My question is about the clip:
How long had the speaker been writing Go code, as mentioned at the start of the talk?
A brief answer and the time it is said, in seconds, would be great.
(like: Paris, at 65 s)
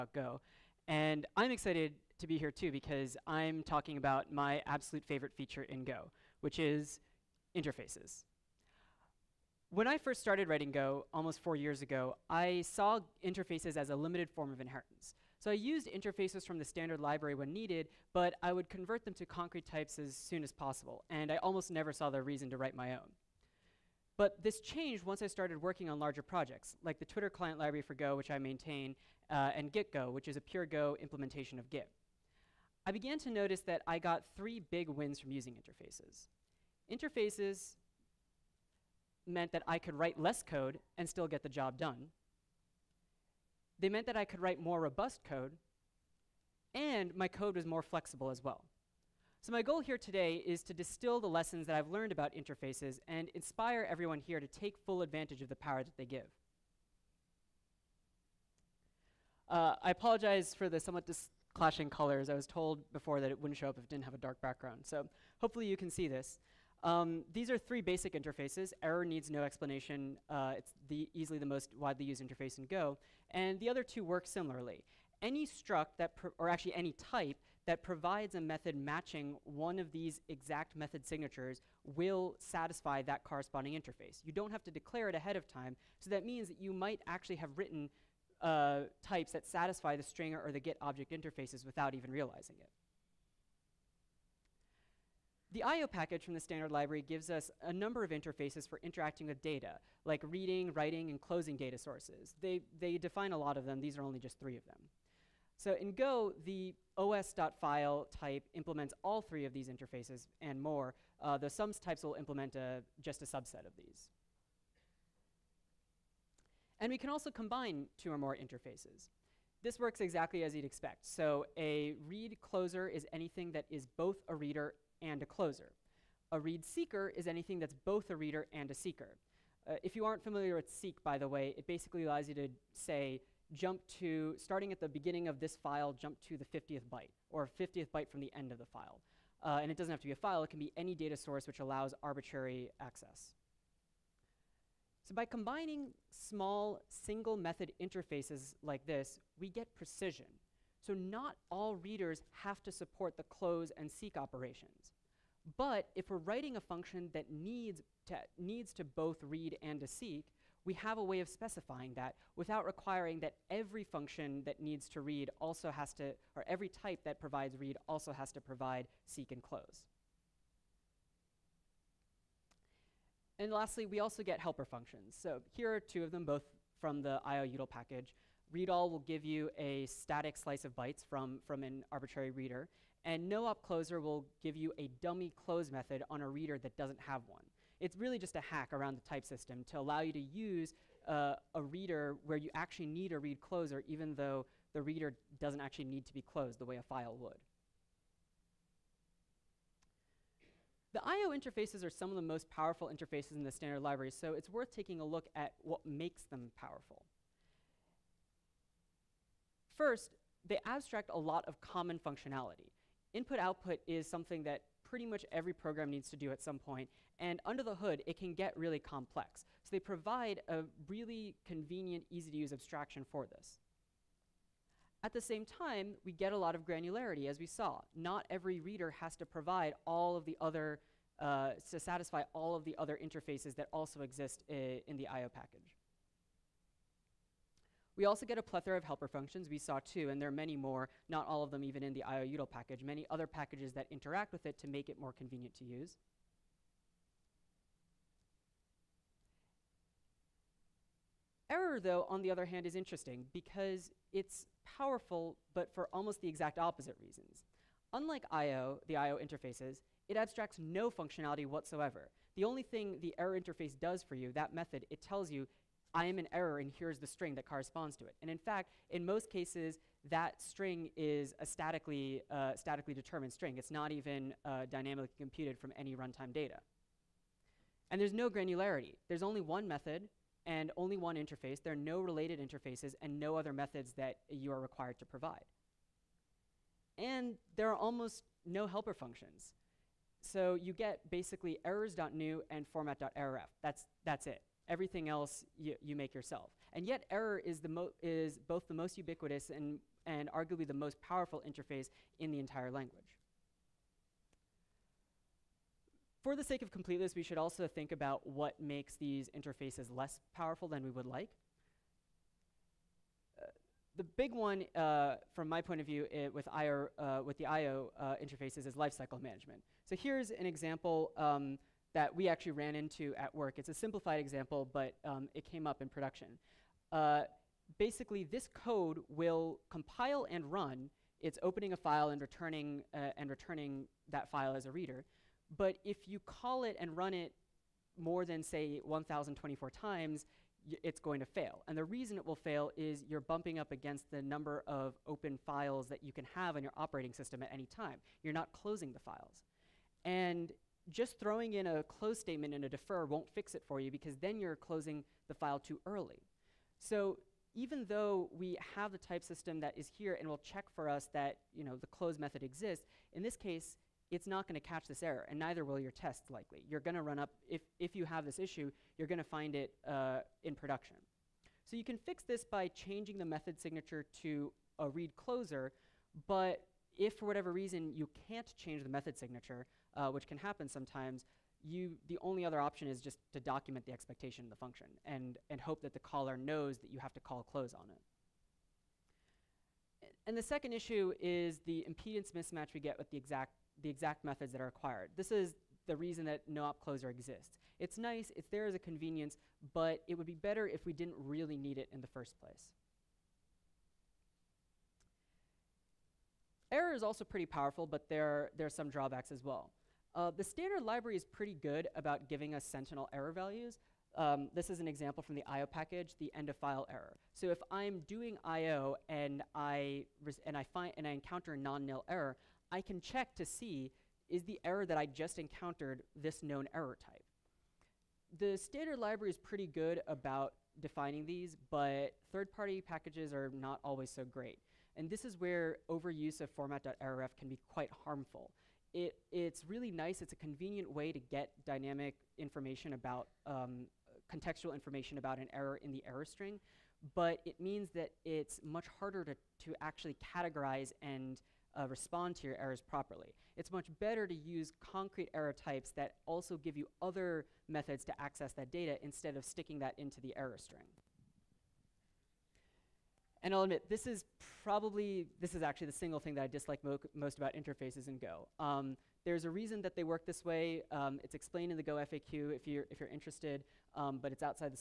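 almost four years, at 11 s.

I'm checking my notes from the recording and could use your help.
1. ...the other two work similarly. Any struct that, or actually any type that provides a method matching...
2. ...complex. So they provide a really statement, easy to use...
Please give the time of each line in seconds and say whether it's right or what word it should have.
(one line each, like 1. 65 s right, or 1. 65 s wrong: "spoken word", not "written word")
1. 73 s right
2. 218 s wrong: "convenient", not "statement".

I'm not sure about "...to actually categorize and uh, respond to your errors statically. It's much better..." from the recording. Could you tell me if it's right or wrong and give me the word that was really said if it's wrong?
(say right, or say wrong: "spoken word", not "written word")
wrong: "properly", not "statically".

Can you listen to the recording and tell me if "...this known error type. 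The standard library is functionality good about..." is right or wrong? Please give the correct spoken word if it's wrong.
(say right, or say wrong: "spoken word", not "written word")
wrong: "pretty", not "functionality".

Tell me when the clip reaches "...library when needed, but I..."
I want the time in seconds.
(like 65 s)
16 s.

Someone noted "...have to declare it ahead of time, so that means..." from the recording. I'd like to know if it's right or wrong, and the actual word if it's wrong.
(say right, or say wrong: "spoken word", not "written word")
right.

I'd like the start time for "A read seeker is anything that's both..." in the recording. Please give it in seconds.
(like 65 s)
126 s.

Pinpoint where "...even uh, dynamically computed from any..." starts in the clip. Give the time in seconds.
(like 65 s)
273 s.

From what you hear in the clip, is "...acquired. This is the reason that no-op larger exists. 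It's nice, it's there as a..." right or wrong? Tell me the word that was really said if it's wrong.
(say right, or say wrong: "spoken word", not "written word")
wrong: "closer", not "larger".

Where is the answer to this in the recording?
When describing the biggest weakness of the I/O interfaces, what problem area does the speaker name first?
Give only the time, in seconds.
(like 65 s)
318 s.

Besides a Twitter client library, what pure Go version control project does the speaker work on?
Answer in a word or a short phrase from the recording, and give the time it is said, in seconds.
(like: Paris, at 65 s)
Git Go, at 29 s.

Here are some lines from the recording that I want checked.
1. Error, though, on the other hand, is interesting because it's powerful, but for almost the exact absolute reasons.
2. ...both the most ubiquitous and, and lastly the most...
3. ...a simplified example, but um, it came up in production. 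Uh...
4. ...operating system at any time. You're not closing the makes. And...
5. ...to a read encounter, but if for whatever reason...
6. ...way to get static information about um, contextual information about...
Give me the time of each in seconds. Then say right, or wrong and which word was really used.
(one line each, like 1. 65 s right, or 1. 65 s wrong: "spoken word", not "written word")
1. 251 s wrong: "opposite", not "absolute"
2. 298 s wrong: "arguably", not "lastly"
3. 323 s right
4. 346 s wrong: "files", not "makes"
5. 374 s wrong: "closer", not "encounter"
6. 440 s wrong: "dynamic", not "static".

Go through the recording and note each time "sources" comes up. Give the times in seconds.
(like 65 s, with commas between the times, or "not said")
101 s, 141 s.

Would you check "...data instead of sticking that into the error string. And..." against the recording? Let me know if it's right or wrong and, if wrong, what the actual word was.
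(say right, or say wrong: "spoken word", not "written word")
right.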